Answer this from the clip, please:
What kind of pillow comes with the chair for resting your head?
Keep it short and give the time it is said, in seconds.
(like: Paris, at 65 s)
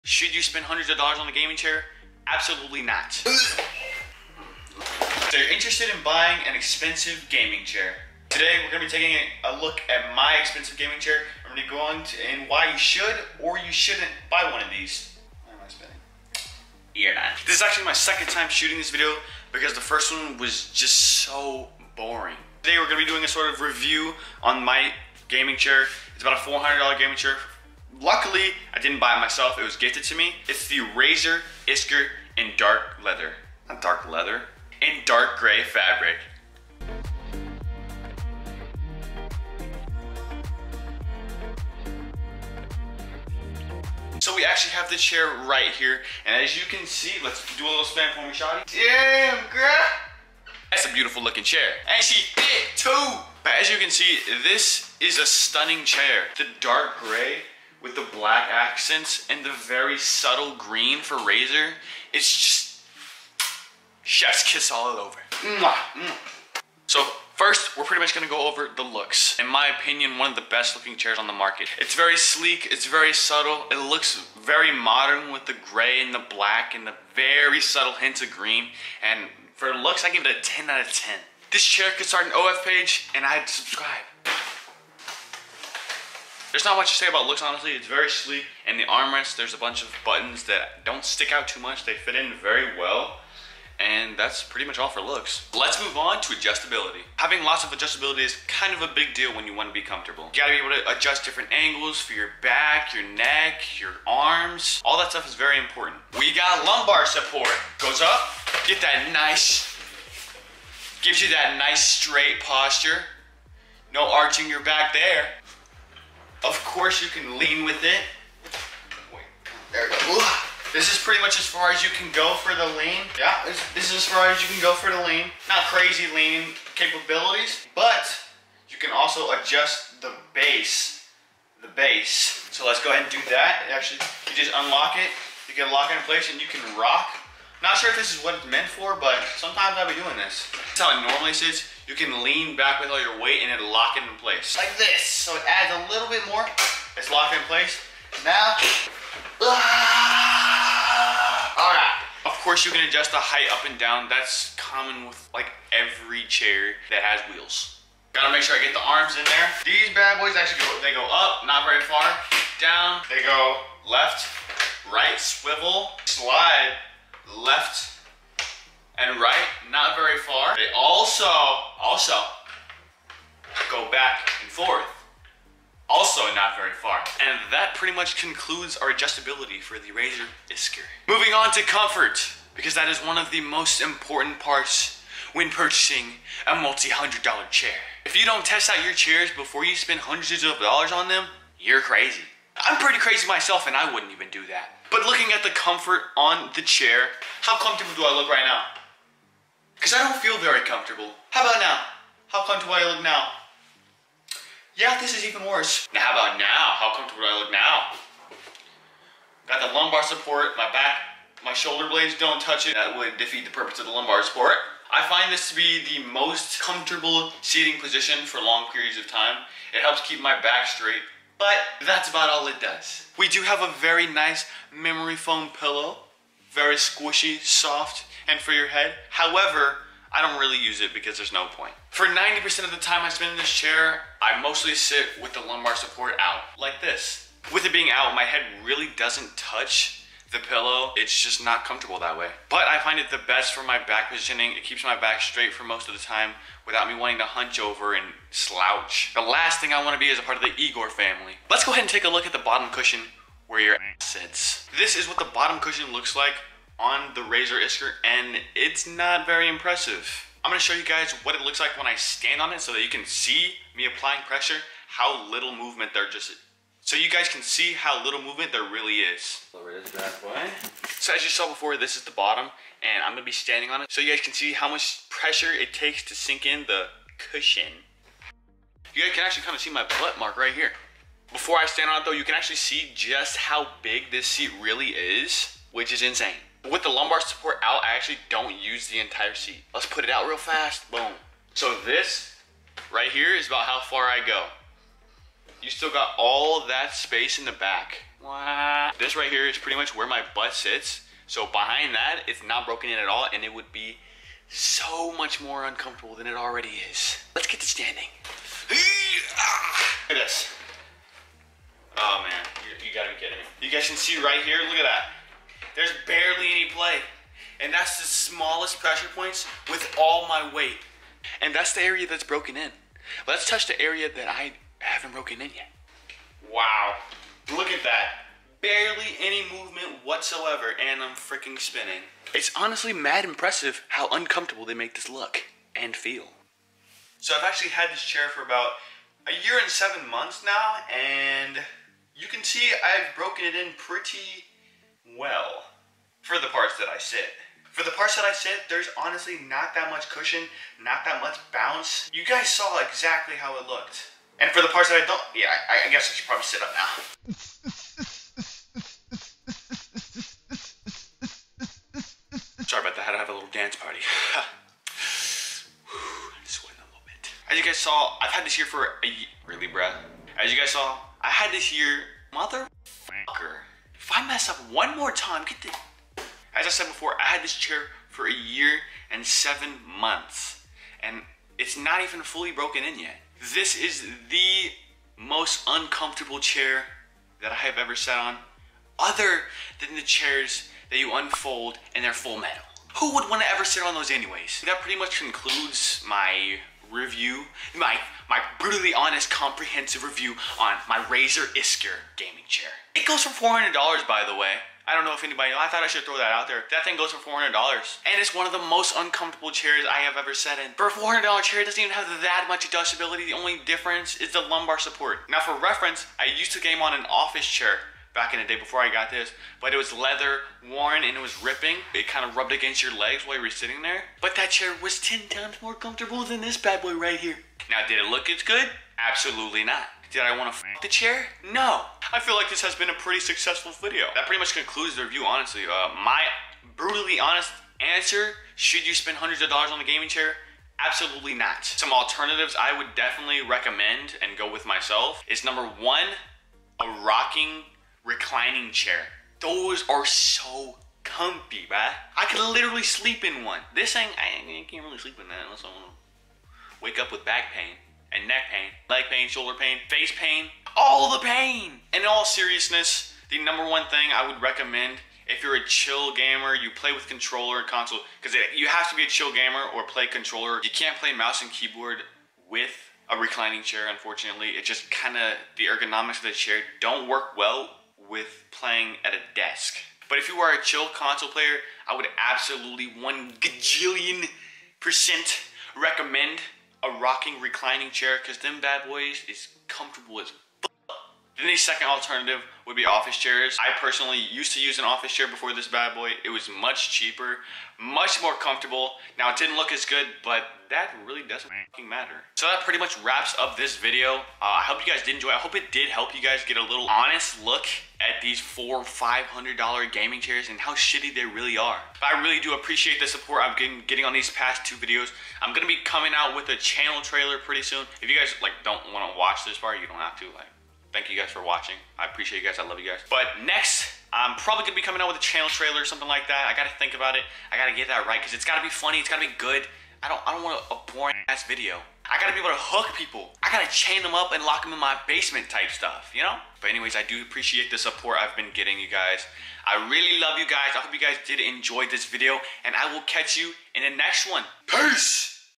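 memory foam pillow, at 224 s.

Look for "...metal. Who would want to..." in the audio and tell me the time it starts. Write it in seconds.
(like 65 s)
392 s.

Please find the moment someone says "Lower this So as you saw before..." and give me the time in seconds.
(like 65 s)
269 s.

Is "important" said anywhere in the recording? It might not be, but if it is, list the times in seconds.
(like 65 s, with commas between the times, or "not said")
105 s, 183 s.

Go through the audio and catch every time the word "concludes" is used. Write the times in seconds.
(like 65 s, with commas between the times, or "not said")
178 s, 395 s, 434 s.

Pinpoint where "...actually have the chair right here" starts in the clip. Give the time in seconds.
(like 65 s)
44 s.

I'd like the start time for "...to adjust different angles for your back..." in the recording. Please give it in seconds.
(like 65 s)
100 s.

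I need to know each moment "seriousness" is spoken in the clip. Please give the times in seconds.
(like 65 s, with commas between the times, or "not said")
462 s.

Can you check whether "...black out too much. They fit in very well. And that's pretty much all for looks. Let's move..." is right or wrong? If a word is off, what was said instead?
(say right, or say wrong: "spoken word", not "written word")
wrong: "stick", not "black".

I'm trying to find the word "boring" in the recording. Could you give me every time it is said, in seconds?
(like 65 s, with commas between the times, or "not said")
21 s, 530 s.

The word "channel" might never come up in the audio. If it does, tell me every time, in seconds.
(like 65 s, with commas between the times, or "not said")
516 s, 525 s.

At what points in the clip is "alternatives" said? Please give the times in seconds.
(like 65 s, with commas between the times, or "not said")
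441 s, 491 s.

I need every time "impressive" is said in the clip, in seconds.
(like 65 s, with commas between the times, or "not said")
259 s, 333 s.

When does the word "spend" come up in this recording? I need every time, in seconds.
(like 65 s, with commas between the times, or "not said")
0 s, 189 s, 233 s, 438 s.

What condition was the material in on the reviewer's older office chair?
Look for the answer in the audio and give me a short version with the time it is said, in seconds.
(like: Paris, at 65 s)
leather worn, at 419 s.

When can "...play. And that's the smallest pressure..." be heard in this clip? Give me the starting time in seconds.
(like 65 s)
316 s.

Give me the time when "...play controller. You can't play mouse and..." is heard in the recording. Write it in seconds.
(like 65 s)
469 s.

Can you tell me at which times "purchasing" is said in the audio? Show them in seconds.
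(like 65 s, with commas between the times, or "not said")
185 s.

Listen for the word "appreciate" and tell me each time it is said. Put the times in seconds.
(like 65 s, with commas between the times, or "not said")
512 s, 522 s, 537 s.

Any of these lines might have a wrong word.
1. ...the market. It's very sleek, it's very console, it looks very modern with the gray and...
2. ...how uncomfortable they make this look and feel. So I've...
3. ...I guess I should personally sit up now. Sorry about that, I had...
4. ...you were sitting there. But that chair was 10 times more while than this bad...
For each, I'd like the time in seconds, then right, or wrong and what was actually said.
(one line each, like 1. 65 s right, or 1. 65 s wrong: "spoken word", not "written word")
1. 71 s wrong: "subtle", not "console"
2. 333 s right
3. 355 s wrong: "probably", not "personally"
4. 423 s wrong: "comfortable", not "while".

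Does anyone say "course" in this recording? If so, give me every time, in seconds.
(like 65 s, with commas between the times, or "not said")
116 s, 152 s.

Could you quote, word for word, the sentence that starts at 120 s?
This is pretty much as far as you can go for the lean.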